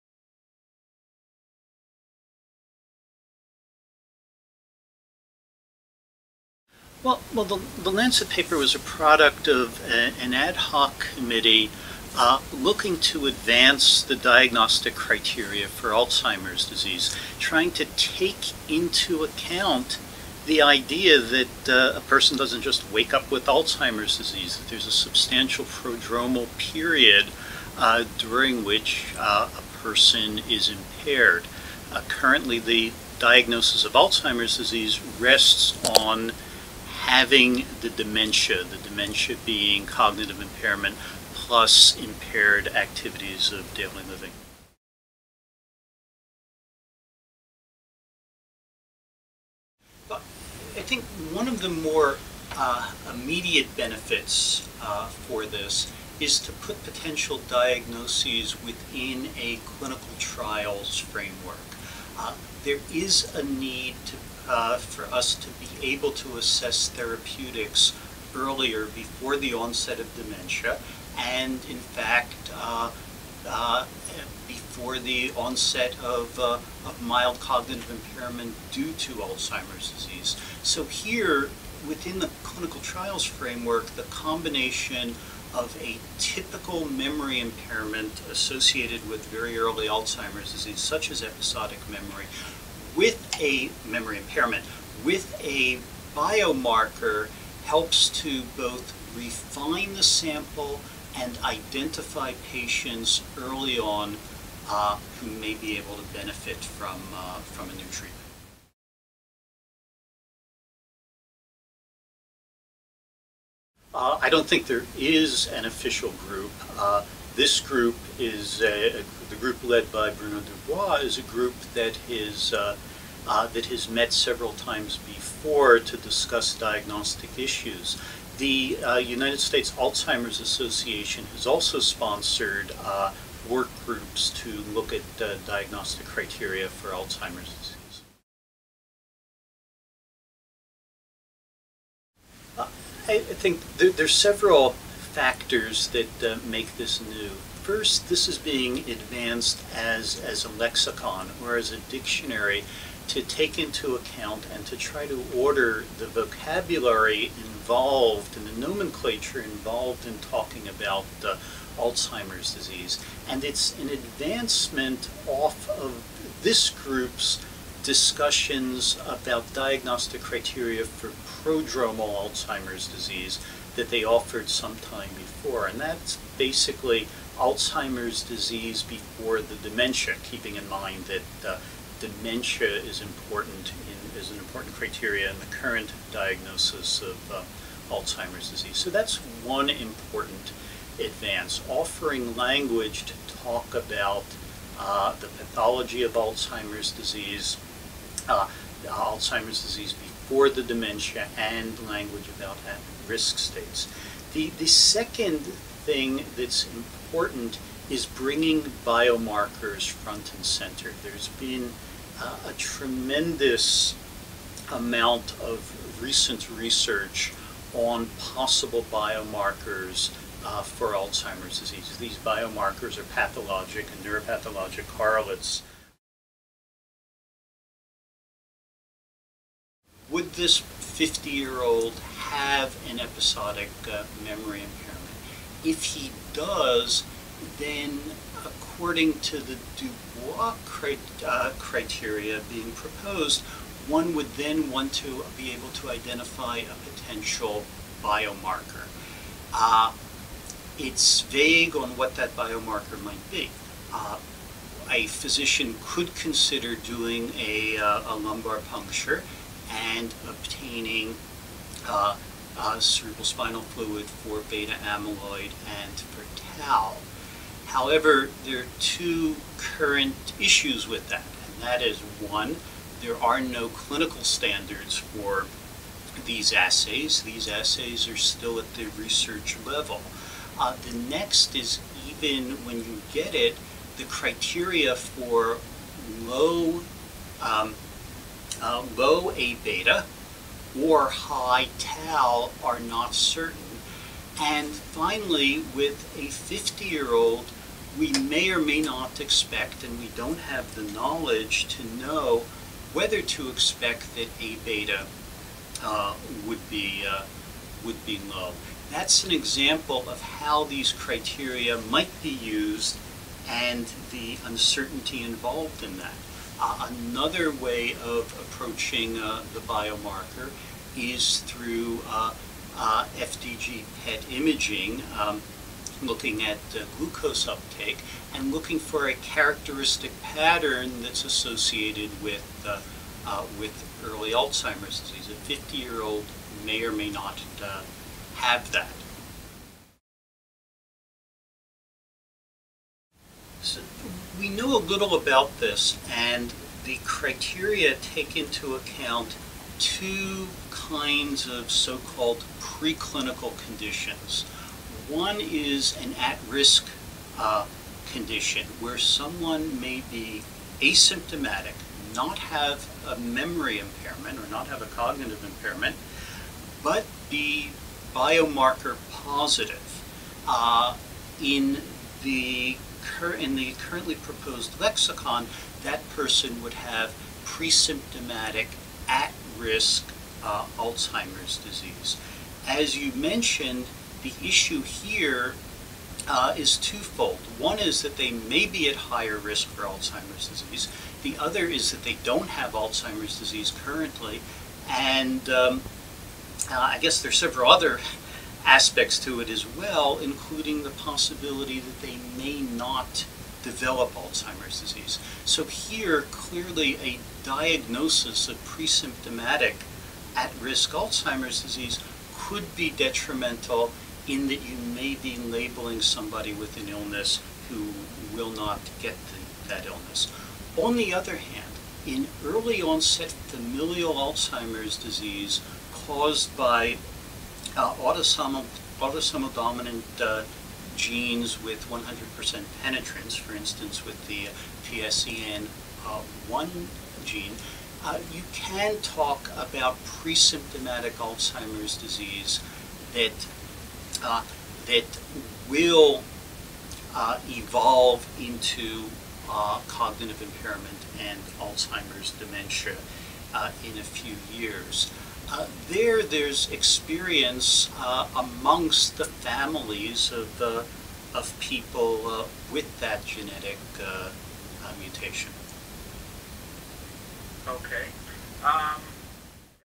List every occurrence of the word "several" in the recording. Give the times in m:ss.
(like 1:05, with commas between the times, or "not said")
2:04, 2:24, 6:37.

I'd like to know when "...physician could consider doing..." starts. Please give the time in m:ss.
4:15.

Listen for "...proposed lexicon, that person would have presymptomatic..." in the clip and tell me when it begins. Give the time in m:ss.
6:14.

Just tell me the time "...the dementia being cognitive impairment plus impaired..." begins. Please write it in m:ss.
0:38.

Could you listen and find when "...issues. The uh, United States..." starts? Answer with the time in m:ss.
2:07.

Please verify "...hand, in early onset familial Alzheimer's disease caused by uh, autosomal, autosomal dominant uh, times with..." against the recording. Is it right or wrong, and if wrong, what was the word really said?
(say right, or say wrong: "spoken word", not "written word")
wrong: "genes", not "times".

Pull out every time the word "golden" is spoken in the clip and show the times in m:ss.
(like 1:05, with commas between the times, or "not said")
not said.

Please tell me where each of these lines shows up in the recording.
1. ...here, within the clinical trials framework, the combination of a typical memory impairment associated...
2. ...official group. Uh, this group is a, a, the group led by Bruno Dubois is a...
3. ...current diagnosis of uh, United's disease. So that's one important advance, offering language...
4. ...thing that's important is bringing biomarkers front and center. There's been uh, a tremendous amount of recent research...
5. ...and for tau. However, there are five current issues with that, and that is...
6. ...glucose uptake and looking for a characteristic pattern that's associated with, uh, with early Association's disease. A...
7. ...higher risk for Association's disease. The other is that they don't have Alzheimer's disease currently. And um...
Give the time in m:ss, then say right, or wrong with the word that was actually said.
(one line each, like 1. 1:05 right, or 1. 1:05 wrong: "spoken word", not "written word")
1. 1:20 right
2. 1:55 right
3. 3:05 wrong: "Alzheimer", not "United"
4. 3:25 right
5. 4:25 wrong: "two", not "five"
6. 5:26 wrong: "Alzheimer", not "Association"
7. 6:28 wrong: "Alzheimer", not "Association".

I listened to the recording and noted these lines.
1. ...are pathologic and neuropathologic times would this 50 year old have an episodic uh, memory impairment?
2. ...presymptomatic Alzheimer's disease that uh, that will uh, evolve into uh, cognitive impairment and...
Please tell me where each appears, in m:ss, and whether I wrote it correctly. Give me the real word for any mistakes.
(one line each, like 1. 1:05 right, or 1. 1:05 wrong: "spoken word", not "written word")
1. 3:42 wrong: "correlates", not "times"
2. 7:20 right.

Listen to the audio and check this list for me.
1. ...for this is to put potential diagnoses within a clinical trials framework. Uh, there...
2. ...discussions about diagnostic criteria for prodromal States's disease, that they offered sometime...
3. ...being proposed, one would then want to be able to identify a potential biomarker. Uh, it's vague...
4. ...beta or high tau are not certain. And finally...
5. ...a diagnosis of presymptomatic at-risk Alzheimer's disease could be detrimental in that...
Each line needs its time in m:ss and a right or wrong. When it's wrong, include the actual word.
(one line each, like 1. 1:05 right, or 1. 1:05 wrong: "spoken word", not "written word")
1. 0:55 right
2. 2:47 wrong: "Alzheimer", not "States"
3. 4:02 right
4. 4:49 right
5. 6:47 right.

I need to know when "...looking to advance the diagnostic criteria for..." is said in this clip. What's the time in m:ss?
0:12.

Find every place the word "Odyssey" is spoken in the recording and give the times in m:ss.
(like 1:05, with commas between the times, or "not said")
not said.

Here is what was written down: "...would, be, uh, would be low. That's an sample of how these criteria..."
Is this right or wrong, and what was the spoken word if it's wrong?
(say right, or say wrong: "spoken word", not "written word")
wrong: "example", not "sample".